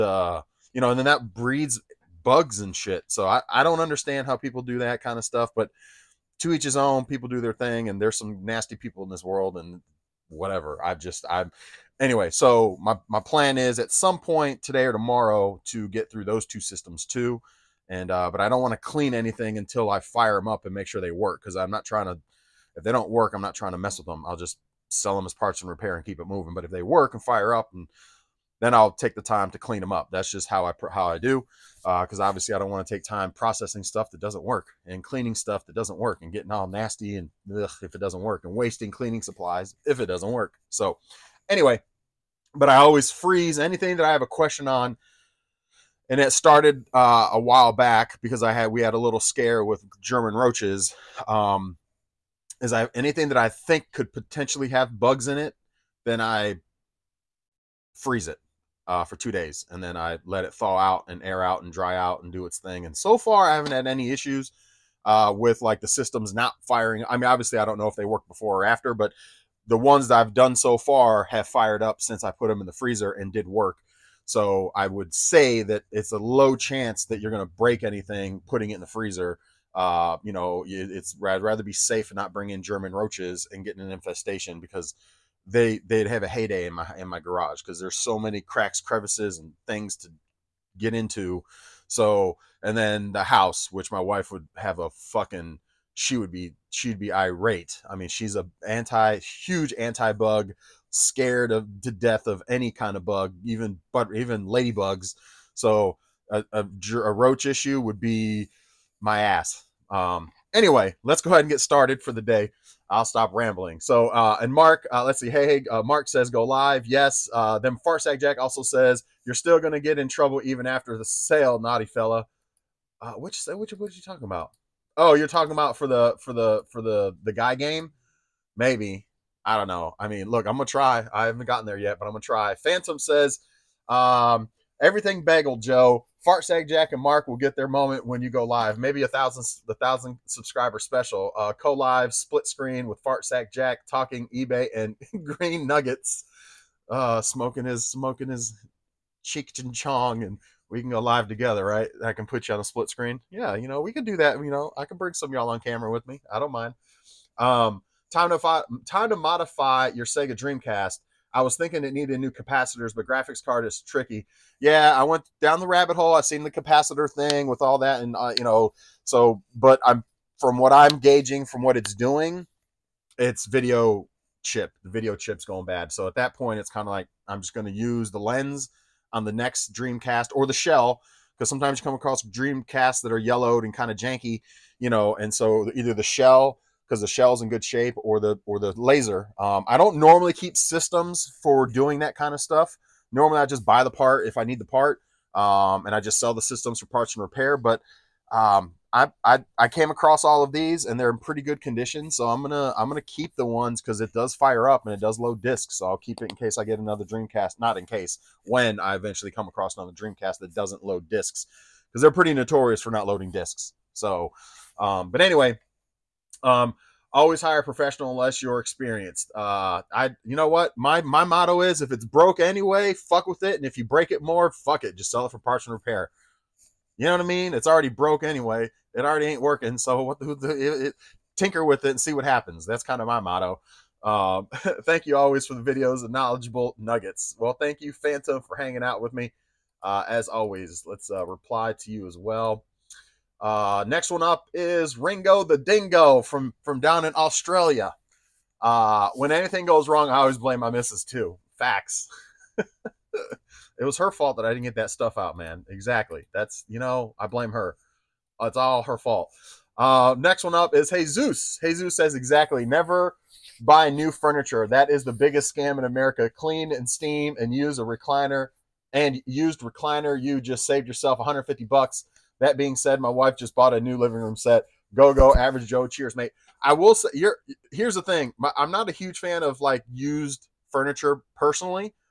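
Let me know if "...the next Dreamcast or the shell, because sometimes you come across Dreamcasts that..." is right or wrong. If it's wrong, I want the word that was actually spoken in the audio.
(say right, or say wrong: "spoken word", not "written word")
right.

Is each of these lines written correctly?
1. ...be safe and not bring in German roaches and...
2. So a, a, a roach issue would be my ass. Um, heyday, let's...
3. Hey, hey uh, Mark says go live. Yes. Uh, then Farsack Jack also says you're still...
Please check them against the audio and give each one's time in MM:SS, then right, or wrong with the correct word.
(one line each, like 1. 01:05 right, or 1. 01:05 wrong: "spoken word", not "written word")
1. 01:21 right
2. 01:45 wrong: "anyway", not "heyday"
3. 01:55 right.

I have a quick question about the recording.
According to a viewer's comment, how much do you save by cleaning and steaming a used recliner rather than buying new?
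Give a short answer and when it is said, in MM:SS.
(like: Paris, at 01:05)
$150, at 04:31.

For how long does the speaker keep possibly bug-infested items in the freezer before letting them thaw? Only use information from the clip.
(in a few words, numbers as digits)
2 days.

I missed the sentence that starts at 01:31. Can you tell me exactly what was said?
So and then the house, which my wife would have a fucking she would be she'd be irate.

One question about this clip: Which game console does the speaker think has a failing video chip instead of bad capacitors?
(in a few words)
Sega Dreamcast.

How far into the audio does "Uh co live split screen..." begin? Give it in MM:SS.
02:21.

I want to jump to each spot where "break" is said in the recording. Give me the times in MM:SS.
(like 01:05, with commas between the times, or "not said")
01:17, 03:43.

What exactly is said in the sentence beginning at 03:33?
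So, um, but anyway, um, always hire a professional unless you're experienced.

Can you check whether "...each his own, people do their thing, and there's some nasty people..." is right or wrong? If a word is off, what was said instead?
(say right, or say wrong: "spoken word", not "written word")
right.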